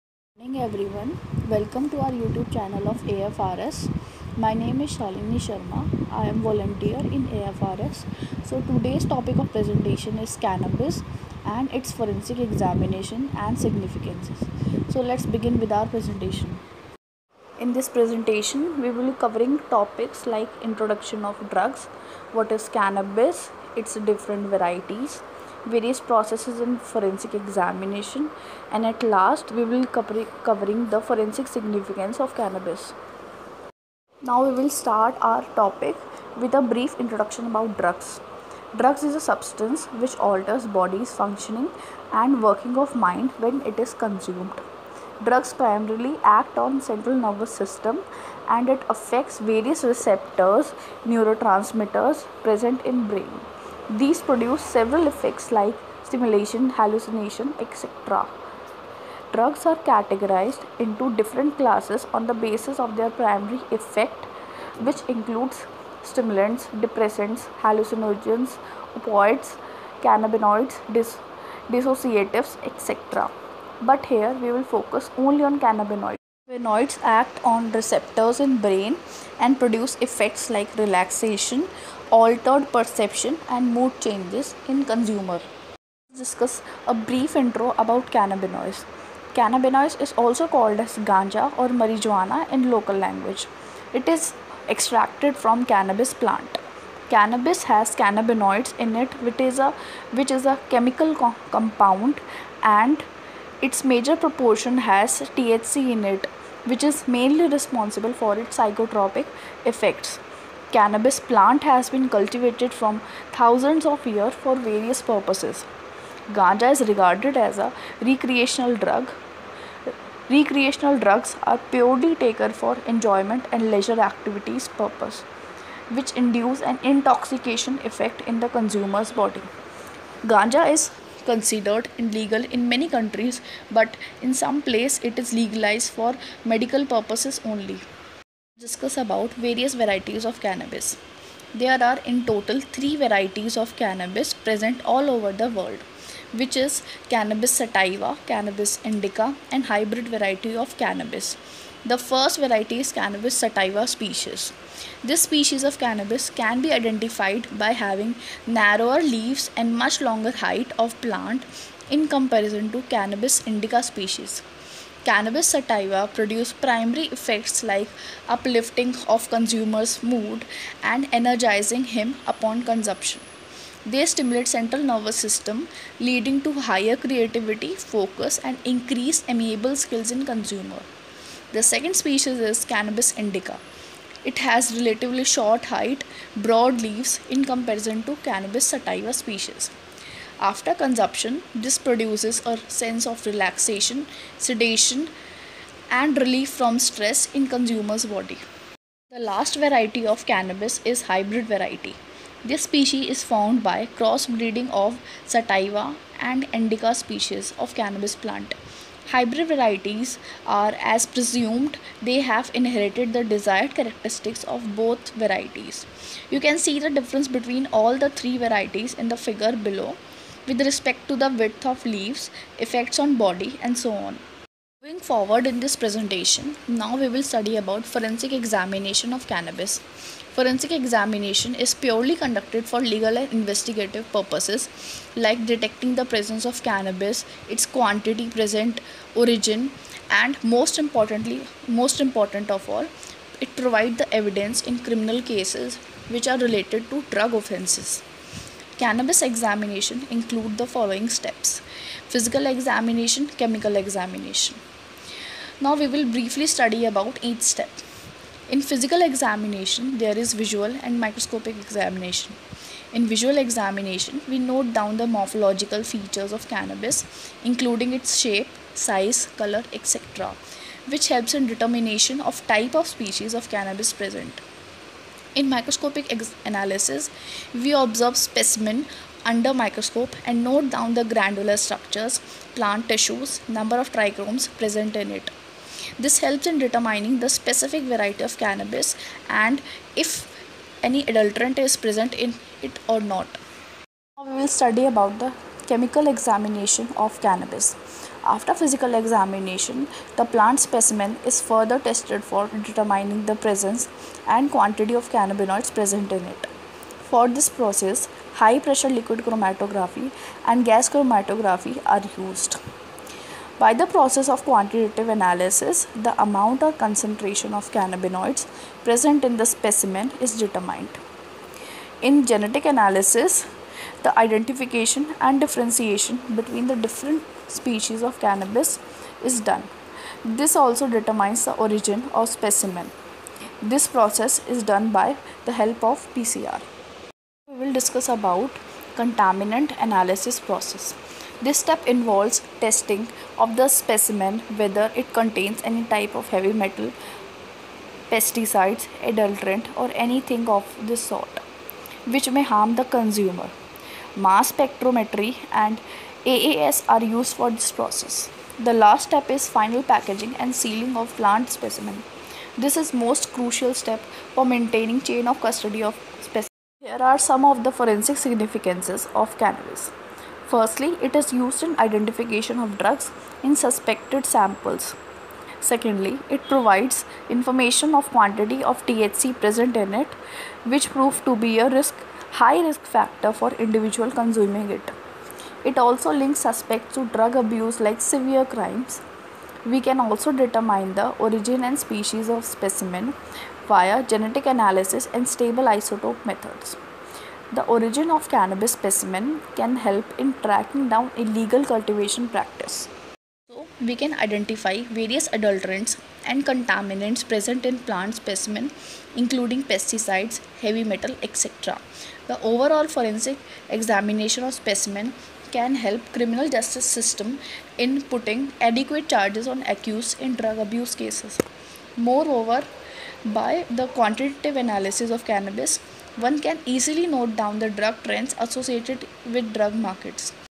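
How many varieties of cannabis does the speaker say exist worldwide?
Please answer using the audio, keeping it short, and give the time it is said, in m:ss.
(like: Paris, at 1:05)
3, at 2:22.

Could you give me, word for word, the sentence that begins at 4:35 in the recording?
In microscopic analysis, we observe specimen under microscope and note down the granular structures, plant tissues, number of trichomes present in it.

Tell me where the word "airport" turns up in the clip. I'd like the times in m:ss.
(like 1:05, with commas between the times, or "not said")
not said.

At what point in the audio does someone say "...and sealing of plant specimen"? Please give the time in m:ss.
6:00.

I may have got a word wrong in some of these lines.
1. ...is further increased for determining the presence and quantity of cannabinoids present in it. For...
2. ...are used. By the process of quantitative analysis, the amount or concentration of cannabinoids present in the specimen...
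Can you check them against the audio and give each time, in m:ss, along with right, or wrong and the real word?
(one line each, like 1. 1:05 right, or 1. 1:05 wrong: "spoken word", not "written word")
1. 5:01 wrong: "tested", not "increased"
2. 5:11 right.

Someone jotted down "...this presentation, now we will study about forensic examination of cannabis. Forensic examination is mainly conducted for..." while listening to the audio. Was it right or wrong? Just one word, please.
wrong.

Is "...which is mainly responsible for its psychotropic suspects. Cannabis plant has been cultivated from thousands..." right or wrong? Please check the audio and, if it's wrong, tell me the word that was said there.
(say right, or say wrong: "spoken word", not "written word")
wrong: "effects", not "suspects".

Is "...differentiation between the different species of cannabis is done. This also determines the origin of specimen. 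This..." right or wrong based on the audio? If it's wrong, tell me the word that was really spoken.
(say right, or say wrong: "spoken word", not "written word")
right.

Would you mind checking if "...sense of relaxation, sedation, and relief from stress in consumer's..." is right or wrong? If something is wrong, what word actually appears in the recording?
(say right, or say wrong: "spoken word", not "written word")
right.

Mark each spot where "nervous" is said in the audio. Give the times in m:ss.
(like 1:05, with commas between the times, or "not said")
0:47, 2:54.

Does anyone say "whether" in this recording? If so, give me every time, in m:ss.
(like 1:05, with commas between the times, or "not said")
5:44.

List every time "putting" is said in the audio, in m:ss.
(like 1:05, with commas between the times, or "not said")
6:58.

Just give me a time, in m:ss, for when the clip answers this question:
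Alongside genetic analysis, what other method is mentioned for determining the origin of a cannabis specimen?
6:35.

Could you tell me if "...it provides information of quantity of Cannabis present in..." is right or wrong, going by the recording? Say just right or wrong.
wrong.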